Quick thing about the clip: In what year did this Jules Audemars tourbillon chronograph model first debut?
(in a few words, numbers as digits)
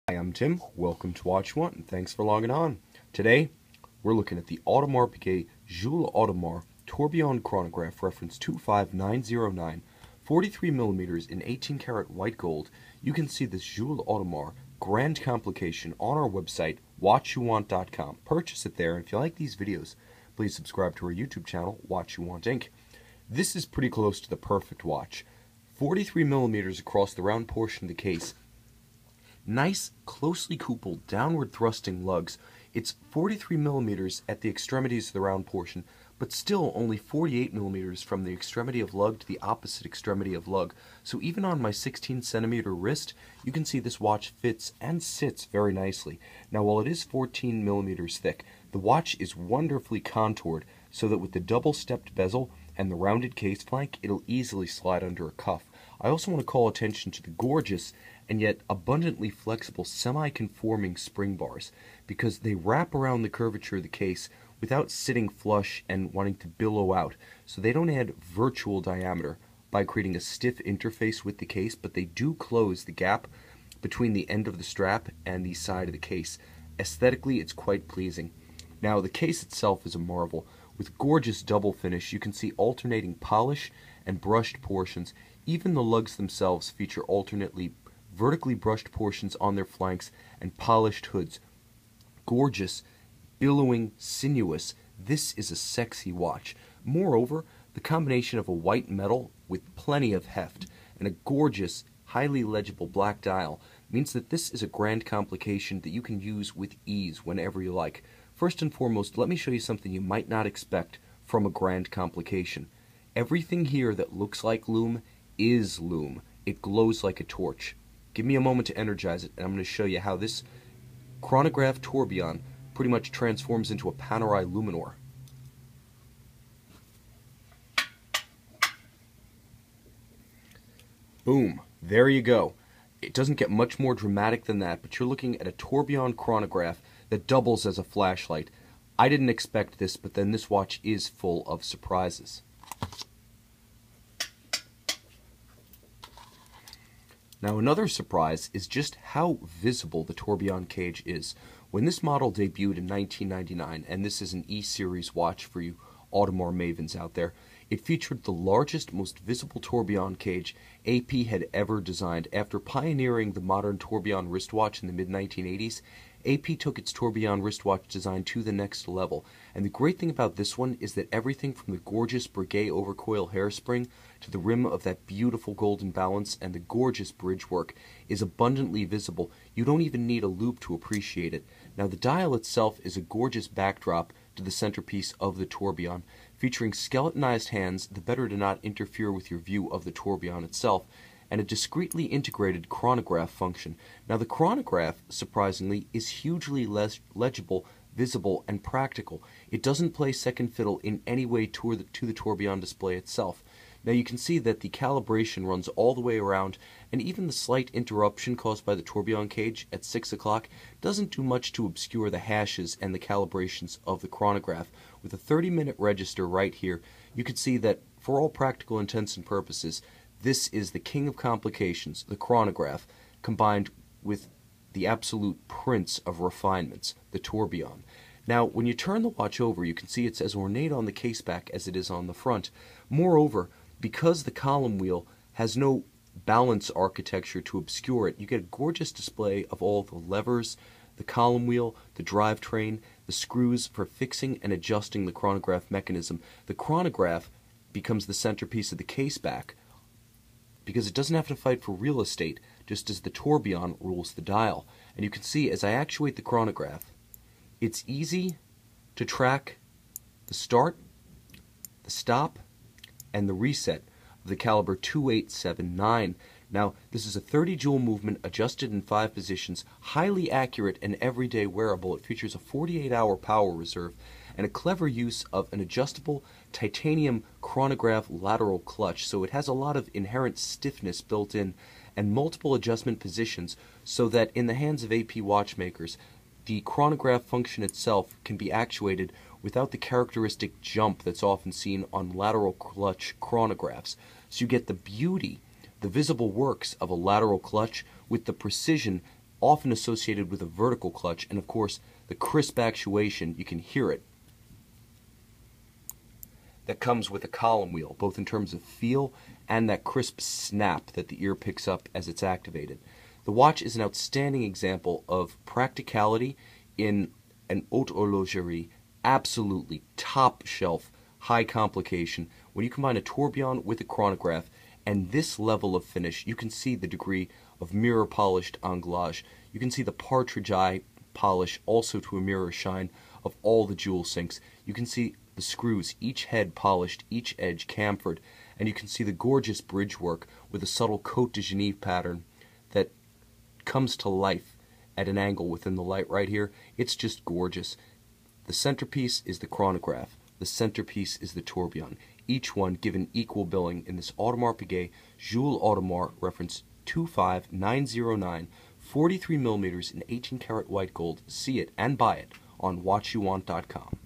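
1999.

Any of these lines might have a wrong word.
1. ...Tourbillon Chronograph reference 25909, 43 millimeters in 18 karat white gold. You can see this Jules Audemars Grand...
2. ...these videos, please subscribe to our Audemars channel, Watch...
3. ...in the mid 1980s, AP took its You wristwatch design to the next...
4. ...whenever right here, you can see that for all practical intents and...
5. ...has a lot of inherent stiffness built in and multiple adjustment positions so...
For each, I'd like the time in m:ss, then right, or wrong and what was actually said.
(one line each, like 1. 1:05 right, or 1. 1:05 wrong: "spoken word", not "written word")
1. 0:06 right
2. 0:19 wrong: "YouTube", not "Audemars"
3. 2:44 wrong: "Tourbillon", not "You"
4. 3:35 wrong: "register", not "whenever"
5. 4:39 right.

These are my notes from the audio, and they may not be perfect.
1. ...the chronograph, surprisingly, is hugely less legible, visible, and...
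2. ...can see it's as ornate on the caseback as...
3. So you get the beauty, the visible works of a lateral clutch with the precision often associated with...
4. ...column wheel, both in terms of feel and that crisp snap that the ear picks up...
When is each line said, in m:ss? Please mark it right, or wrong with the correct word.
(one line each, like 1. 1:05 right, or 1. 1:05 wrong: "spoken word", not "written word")
1. 3:14 right
2. 3:49 right
3. 4:54 right
4. 5:07 right.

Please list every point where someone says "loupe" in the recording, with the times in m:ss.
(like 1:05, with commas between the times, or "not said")
3:00.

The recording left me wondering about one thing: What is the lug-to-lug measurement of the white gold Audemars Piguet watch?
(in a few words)
48 millimeters.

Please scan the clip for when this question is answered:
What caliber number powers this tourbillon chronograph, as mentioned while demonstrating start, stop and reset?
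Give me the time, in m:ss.
4:24.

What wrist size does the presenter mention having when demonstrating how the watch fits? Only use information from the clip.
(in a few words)
16 centimeters.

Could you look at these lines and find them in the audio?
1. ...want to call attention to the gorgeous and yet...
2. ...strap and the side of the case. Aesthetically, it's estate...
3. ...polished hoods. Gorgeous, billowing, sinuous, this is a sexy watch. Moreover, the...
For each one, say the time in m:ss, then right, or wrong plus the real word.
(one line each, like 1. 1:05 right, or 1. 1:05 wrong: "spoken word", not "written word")
1. 0:56 right
2. 1:14 wrong: "quite", not "estate"
3. 1:30 right.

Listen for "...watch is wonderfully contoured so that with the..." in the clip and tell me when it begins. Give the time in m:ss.
0:48.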